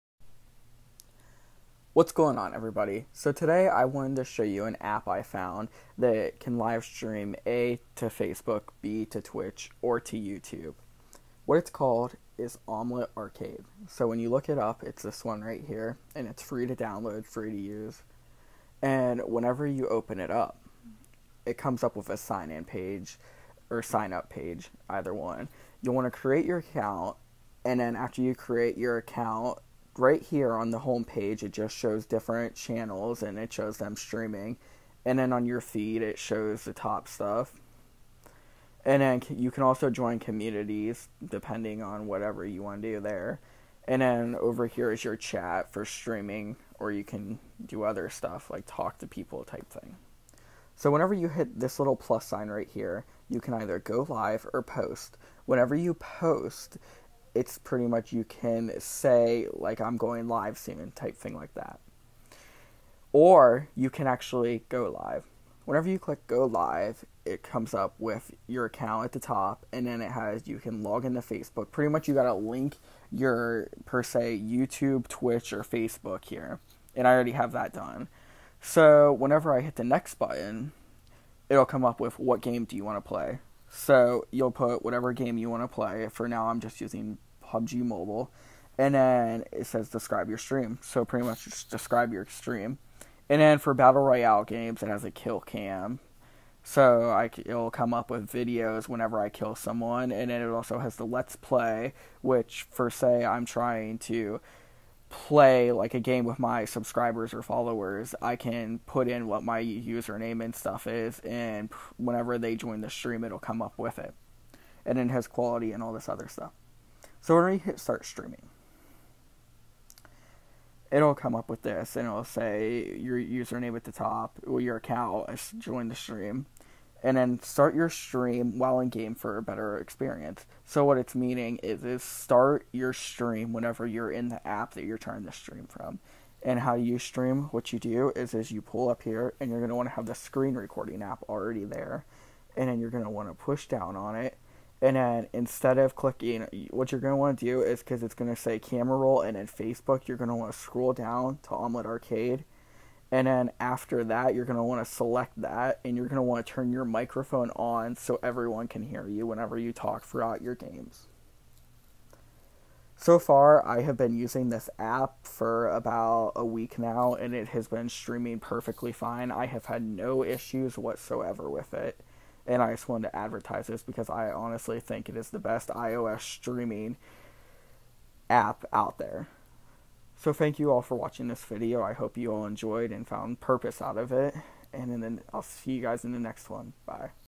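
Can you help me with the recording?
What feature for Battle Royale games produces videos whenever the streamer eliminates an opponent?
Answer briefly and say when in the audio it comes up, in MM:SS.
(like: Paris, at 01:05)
Kill cam, at 01:35.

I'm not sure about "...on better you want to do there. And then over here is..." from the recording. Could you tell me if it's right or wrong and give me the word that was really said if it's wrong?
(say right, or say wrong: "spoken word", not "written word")
wrong: "whatever", not "better".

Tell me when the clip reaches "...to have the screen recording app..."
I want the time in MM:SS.
02:19.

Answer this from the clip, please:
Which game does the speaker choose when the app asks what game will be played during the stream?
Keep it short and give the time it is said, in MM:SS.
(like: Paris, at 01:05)
PUBG Mobile, at 01:27.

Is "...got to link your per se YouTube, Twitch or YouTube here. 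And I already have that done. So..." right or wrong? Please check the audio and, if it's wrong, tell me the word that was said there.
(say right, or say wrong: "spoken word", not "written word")
wrong: "Facebook", not "YouTube".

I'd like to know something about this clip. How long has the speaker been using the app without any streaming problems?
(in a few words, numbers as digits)
About a week.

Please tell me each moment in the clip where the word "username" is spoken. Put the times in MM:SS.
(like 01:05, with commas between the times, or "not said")
01:49, 02:03.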